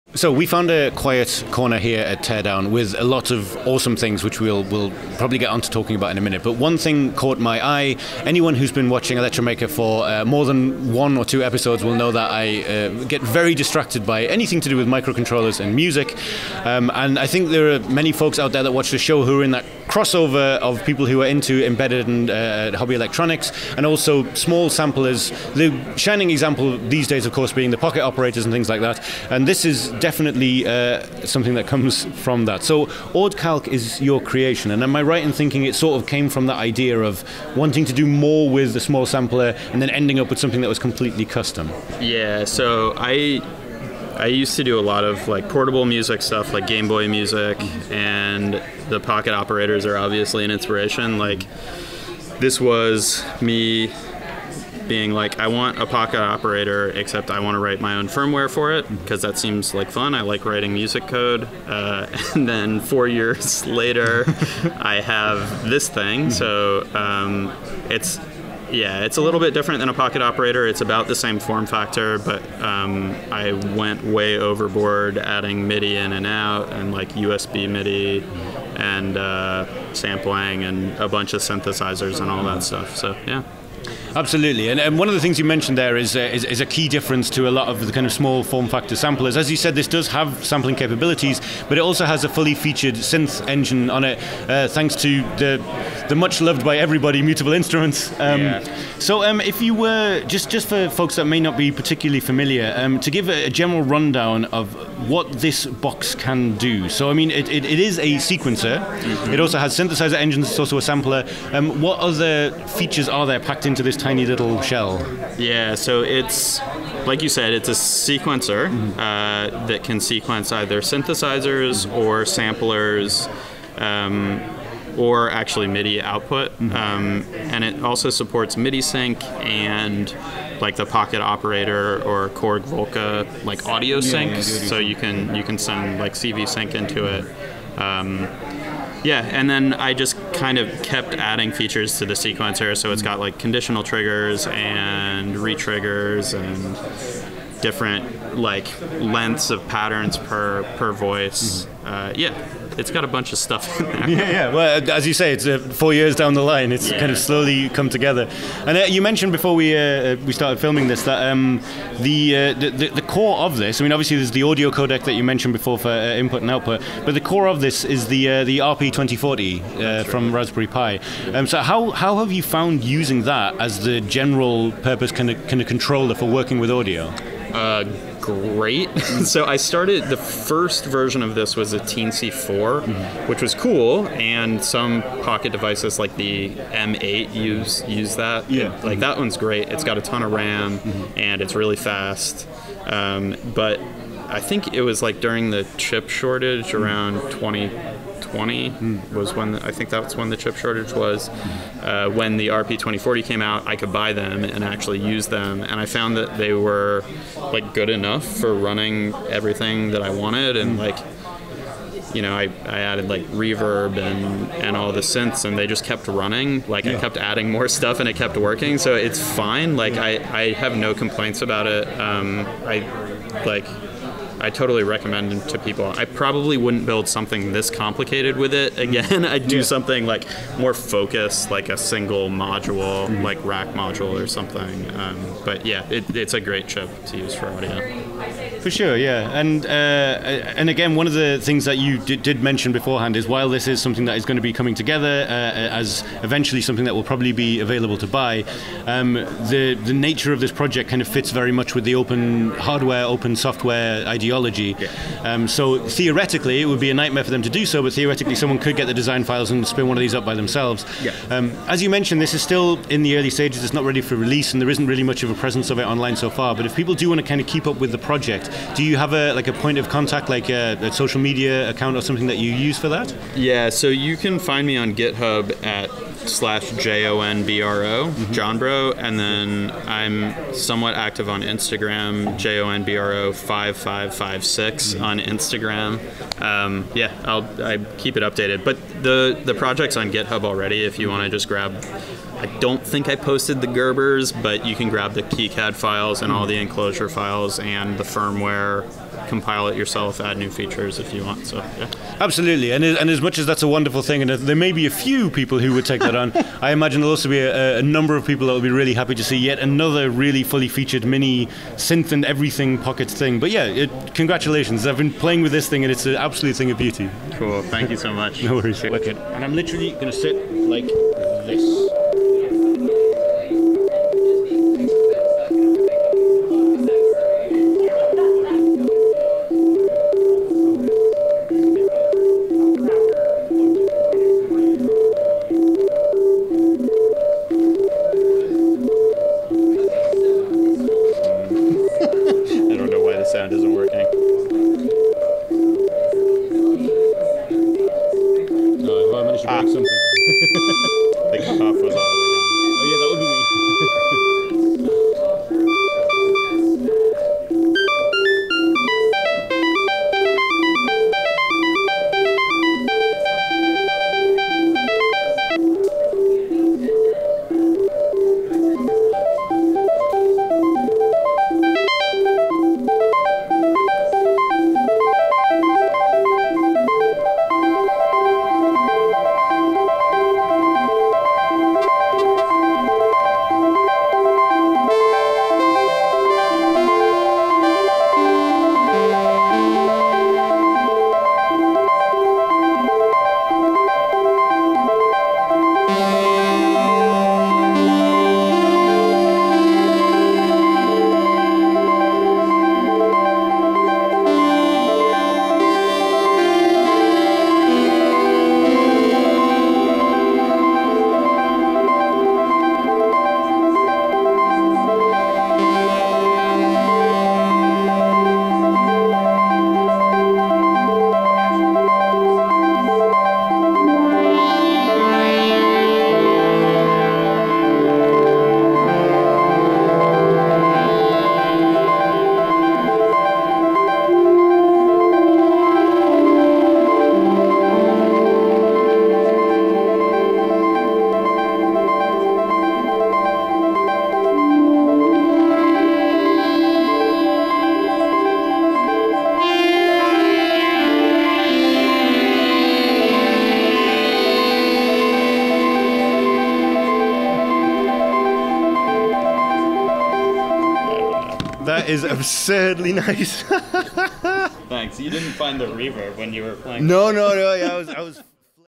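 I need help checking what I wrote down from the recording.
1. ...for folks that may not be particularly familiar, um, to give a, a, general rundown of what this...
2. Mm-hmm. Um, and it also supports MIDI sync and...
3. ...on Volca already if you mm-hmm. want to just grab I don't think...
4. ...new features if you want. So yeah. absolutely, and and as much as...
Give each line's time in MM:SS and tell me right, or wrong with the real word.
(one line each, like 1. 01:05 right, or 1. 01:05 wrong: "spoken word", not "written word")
1. 01:40 right
2. 02:06 right
3. 04:49 wrong: "GitHub", not "Volca"
4. 05:00 right.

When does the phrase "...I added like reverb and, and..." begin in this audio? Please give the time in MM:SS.
03:32.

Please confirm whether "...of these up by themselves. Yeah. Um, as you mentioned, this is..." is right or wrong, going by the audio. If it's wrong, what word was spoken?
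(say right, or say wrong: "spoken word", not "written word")
right.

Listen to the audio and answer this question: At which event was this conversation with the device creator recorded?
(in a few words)
Teardown.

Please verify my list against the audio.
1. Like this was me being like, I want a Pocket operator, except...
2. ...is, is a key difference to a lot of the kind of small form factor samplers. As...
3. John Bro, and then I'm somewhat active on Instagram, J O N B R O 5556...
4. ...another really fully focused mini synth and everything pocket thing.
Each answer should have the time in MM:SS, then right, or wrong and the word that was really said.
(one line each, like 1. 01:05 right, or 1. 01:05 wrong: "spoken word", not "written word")
1. 00:51 right
2. 01:26 right
3. 04:38 right
4. 05:09 wrong: "featured", not "focused".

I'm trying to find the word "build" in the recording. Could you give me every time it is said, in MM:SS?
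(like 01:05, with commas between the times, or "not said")
03:46.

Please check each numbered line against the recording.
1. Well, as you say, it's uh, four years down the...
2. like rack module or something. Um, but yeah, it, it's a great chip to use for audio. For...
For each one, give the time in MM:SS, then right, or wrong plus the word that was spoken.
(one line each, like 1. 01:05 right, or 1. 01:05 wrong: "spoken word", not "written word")
1. 02:34 right
2. 03:53 right.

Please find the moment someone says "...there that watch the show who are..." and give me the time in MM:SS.
00:18.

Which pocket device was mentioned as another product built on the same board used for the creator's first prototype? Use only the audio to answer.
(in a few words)
M8.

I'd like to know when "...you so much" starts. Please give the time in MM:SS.
05:17.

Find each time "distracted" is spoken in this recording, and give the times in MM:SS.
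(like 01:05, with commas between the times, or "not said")
00:13.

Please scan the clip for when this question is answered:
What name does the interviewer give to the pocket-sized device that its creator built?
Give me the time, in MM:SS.
00:33.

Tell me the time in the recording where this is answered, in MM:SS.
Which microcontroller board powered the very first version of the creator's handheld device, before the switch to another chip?
03:01.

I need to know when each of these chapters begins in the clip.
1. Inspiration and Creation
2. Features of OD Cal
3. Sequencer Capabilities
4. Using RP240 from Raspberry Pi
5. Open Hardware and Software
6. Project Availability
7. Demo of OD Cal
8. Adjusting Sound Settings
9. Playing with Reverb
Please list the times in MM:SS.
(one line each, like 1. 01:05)
1. 00:34
2. 01:25
3. 01:55
4. 02:35
5. 04:02
6. 04:48
7. 05:16
8. 05:42
9. 06:17.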